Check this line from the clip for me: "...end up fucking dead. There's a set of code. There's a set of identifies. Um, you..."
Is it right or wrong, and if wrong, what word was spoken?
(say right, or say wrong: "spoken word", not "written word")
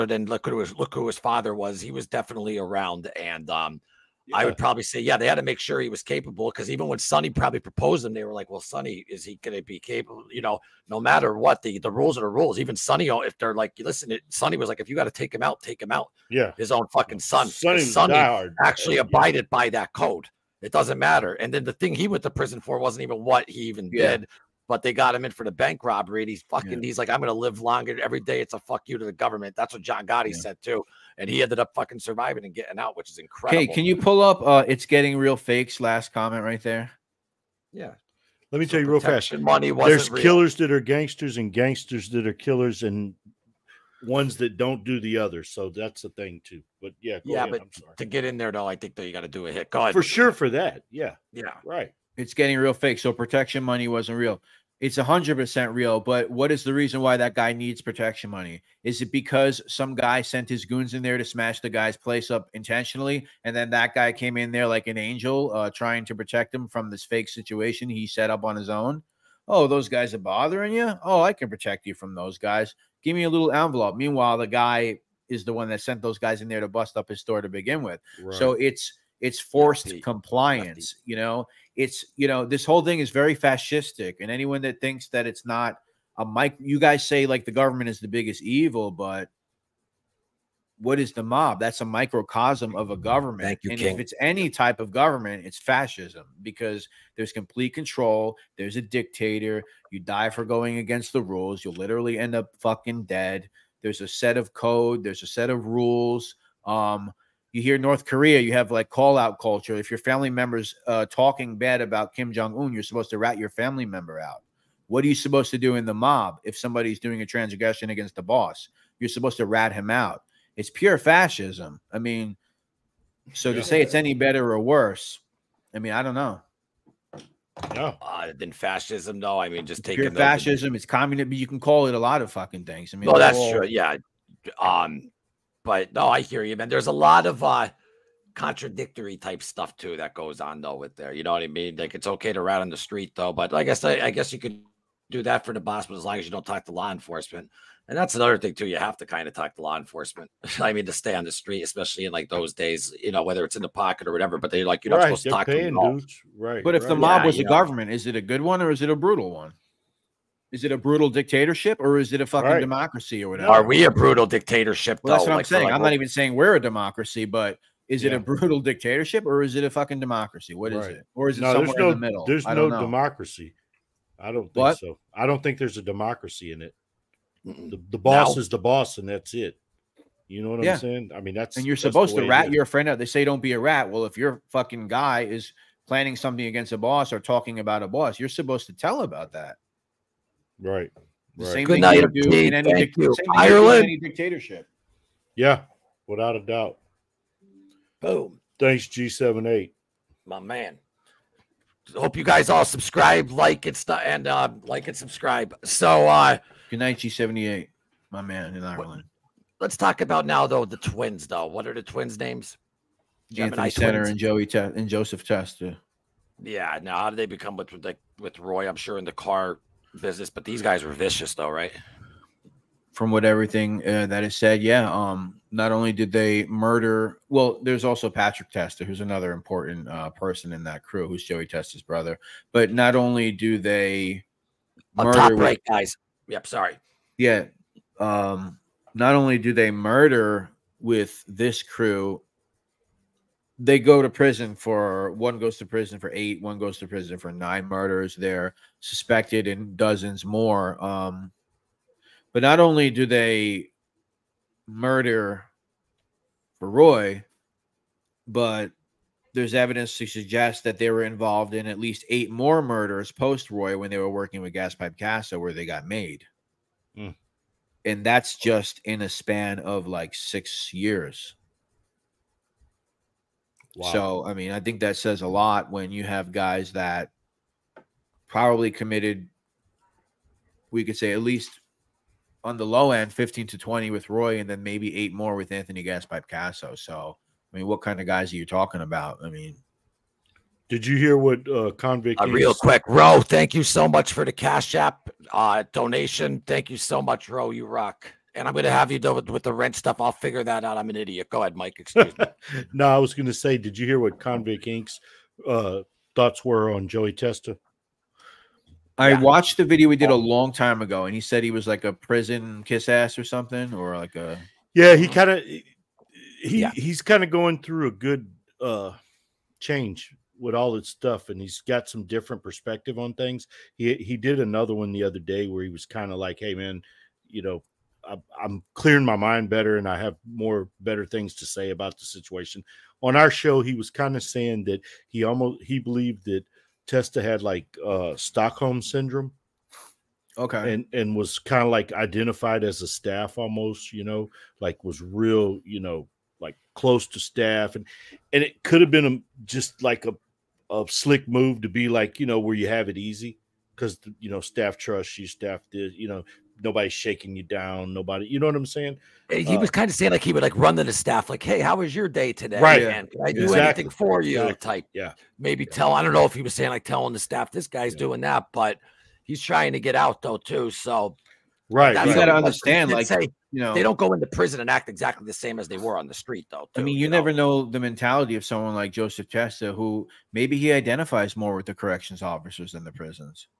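wrong: "rules", not "identifies".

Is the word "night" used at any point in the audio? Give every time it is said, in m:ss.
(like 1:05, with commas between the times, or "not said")
3:11, 3:26.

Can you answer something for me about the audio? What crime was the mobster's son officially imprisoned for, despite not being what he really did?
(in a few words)
bank robbery.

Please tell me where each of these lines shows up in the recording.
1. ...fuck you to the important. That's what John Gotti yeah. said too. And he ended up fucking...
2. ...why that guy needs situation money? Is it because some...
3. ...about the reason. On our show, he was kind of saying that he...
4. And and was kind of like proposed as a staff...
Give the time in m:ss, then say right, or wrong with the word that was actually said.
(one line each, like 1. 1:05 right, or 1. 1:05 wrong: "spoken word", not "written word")
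1. 0:28 wrong: "government", not "important"
2. 0:57 wrong: "protection", not "situation"
3. 5:31 wrong: "situation", not "reason"
4. 5:40 wrong: "identified", not "proposed".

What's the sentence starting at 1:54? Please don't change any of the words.
What are you supposed to do in the mob if somebody's doing a transgression against the boss?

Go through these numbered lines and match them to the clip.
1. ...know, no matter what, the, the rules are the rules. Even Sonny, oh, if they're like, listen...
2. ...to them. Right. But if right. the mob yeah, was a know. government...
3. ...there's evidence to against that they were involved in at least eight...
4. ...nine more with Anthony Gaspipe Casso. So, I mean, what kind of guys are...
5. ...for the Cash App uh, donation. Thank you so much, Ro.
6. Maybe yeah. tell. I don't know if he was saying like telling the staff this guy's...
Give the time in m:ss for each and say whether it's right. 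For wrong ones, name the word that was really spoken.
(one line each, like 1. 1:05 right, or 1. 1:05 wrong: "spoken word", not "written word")
1. 0:10 right
2. 2:35 right
3. 4:19 wrong: "suggest", not "against"
4. 4:44 wrong: "eight", not "nine"
5. 4:54 right
6. 6:05 right.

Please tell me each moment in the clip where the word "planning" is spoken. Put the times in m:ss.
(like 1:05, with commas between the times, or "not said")
3:05.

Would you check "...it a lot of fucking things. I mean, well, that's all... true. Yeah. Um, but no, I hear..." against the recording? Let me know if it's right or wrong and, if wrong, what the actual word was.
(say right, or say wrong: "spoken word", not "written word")
right.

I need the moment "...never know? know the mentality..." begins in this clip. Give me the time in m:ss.
6:17.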